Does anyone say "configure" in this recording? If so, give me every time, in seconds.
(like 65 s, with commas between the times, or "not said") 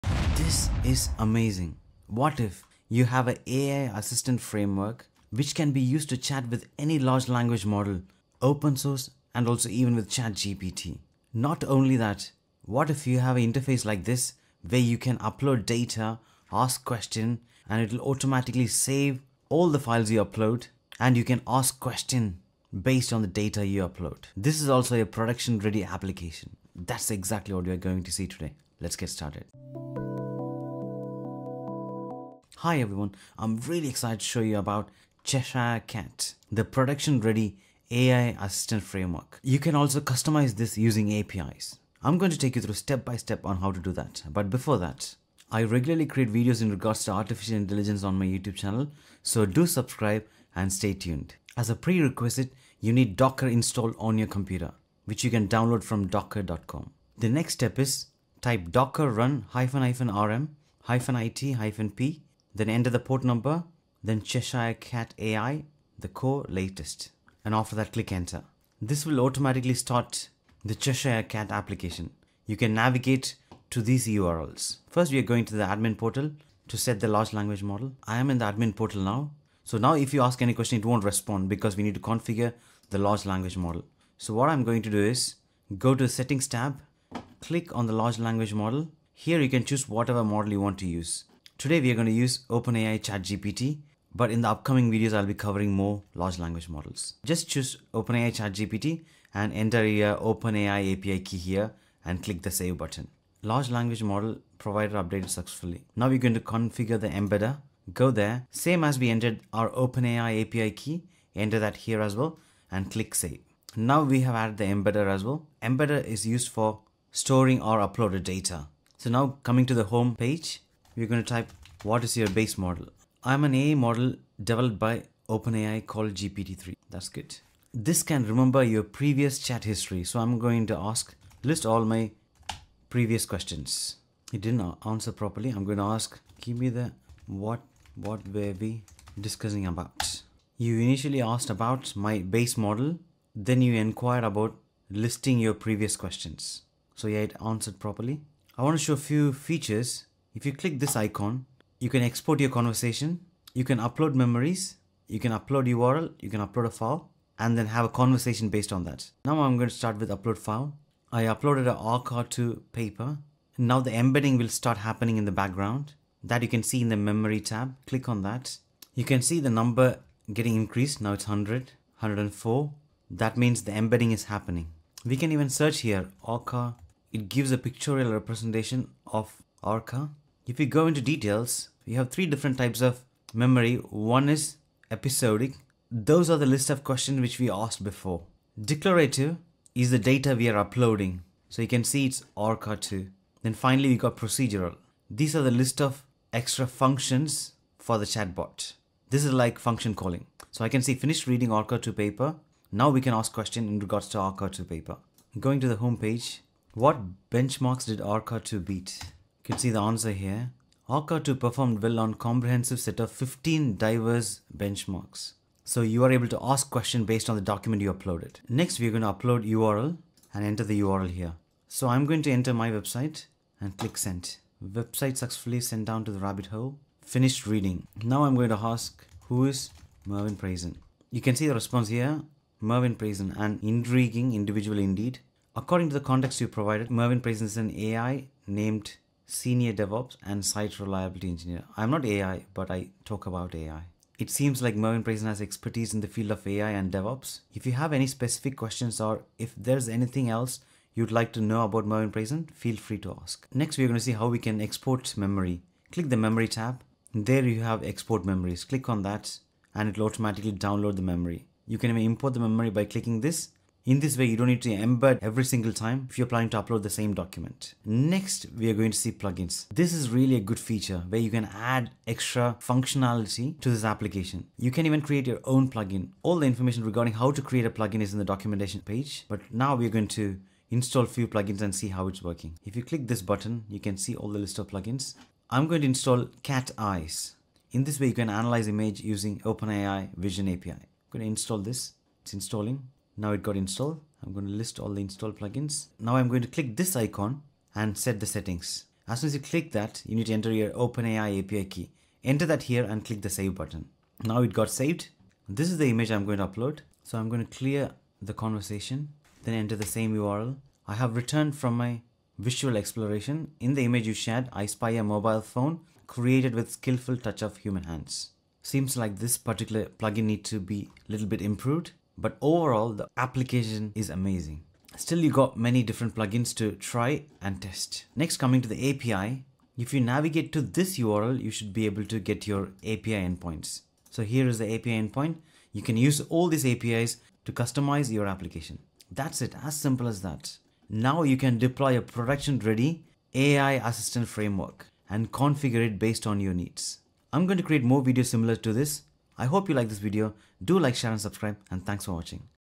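81 s, 106 s, 345 s.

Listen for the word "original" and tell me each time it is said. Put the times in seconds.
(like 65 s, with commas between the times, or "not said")
not said.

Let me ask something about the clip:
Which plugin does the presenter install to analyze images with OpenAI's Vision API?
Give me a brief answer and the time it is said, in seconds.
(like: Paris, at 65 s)
Cat Eyes, at 286 s.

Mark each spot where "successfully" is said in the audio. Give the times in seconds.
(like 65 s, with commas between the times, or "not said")
105 s, 225 s.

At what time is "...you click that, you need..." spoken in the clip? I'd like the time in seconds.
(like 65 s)
299 s.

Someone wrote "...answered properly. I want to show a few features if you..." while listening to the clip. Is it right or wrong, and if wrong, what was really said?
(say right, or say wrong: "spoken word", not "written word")
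right.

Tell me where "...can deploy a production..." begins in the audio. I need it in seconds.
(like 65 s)
341 s.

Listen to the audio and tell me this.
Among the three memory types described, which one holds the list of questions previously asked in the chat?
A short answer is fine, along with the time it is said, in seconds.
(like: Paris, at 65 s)
Episodic, at 184 s.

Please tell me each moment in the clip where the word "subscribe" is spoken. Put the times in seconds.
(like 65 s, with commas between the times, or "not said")
49 s, 351 s.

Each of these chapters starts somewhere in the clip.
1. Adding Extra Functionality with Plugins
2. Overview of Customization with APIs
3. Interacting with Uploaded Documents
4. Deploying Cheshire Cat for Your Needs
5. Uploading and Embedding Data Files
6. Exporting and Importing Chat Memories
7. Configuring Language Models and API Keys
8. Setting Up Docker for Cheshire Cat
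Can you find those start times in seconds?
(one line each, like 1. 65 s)
1. 270 s
2. 32 s
3. 207 s
4. 340 s
5. 159 s
6. 253 s
7. 85 s
8. 51 s.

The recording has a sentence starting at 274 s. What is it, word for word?
You can even create your own plugin.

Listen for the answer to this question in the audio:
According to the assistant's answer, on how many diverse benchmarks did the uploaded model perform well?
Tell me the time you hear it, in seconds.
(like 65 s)
213 s.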